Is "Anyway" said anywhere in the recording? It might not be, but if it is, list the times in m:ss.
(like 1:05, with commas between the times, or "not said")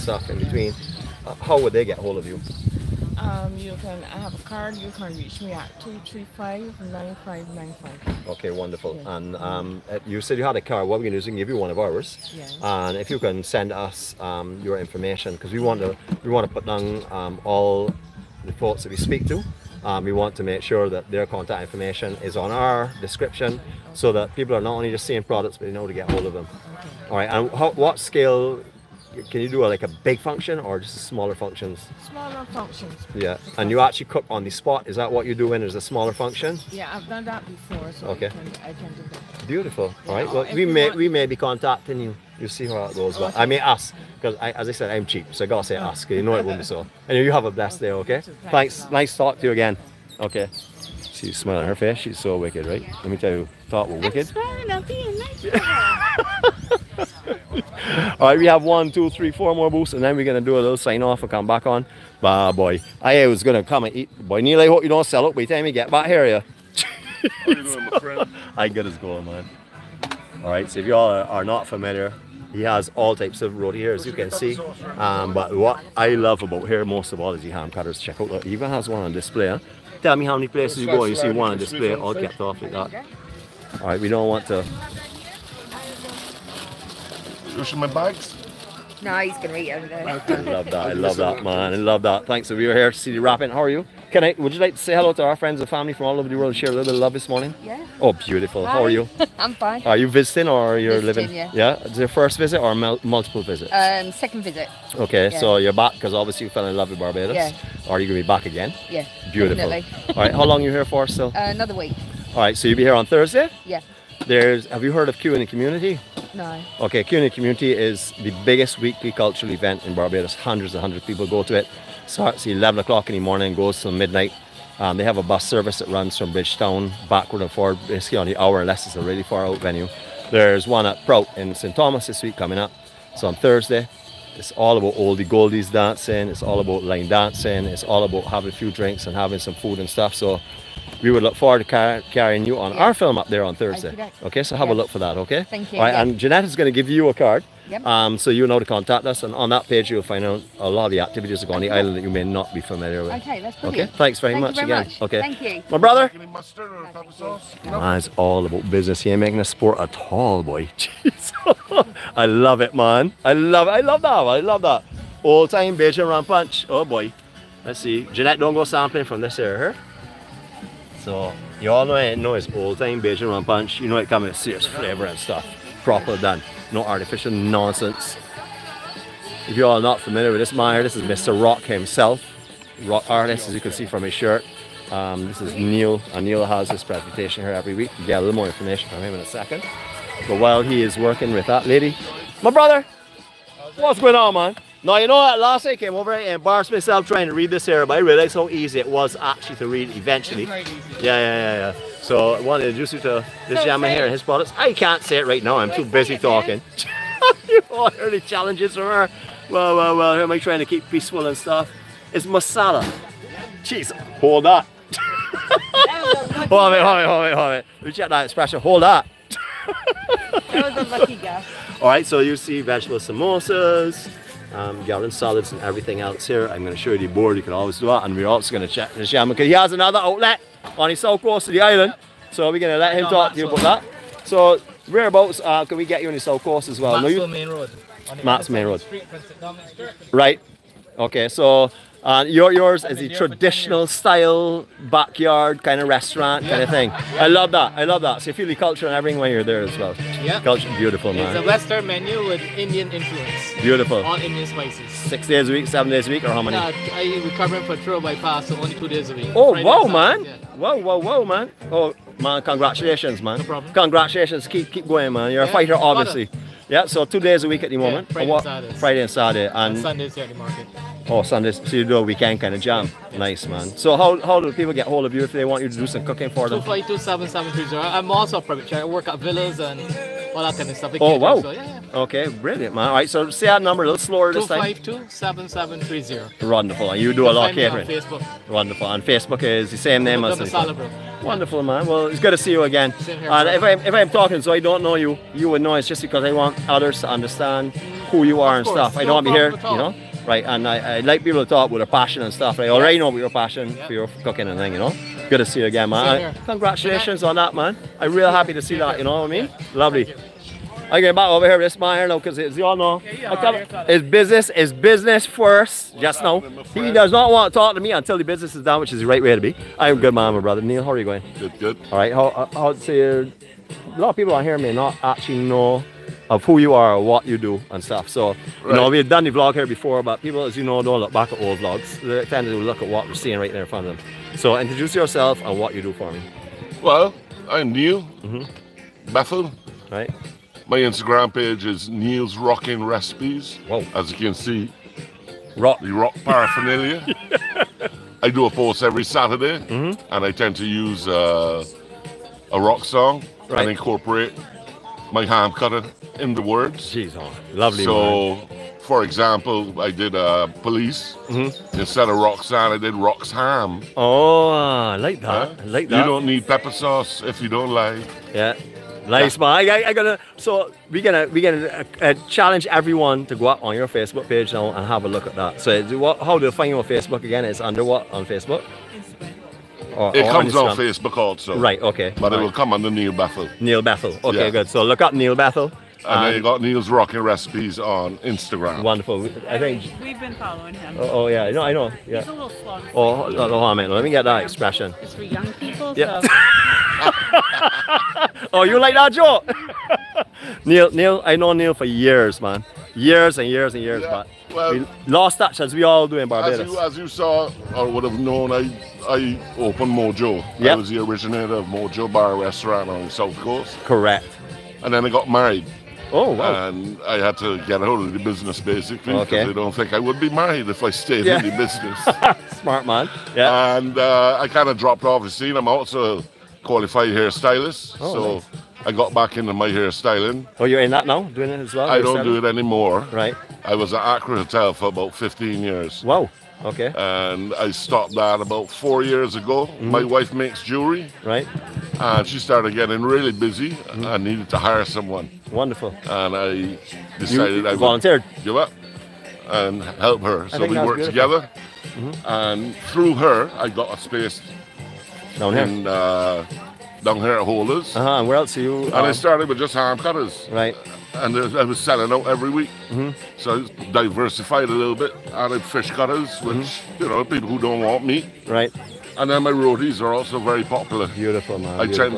0:47.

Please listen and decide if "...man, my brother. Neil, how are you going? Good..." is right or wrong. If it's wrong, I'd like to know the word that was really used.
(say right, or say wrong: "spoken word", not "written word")
right.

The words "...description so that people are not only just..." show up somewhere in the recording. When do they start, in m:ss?
0:22.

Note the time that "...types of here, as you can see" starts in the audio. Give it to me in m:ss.
1:13.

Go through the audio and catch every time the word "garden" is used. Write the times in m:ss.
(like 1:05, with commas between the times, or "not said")
3:44.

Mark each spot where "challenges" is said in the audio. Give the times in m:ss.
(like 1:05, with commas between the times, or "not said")
3:28, 6:12.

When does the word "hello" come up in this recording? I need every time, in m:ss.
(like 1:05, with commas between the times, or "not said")
1:34.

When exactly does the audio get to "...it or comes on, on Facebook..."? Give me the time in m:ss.
6:20.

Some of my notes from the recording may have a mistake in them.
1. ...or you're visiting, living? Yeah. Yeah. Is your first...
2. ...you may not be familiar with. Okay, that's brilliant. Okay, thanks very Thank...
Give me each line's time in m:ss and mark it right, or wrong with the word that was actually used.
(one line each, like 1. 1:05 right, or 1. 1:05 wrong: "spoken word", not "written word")
1. 1:40 right
2. 2:32 right.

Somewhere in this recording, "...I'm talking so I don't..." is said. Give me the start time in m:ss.
4:53.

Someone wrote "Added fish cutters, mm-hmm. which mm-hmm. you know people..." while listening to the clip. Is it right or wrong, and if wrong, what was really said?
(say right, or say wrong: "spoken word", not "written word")
right.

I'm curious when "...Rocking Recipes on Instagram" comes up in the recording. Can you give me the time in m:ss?
6:26.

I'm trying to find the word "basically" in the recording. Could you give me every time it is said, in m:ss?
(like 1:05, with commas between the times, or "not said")
2:07, 6:58.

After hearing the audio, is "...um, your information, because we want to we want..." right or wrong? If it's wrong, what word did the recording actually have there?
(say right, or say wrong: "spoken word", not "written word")
right.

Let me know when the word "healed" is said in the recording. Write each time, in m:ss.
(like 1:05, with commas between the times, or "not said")
not said.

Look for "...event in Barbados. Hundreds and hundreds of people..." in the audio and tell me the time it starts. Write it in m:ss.
1:59.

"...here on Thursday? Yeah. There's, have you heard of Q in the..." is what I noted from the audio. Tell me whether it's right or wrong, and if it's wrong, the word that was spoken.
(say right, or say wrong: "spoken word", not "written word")
right.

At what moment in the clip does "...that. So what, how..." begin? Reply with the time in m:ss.
6:15.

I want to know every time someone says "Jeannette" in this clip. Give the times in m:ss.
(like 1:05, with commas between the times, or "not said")
2:26, 2:48.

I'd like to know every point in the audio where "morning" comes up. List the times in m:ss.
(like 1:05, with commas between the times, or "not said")
1:37, 2:03.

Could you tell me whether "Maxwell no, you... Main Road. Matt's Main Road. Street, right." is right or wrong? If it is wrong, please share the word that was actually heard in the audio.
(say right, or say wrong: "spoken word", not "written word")
right.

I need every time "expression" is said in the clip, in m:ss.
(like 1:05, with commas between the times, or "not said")
3:38, 6:34.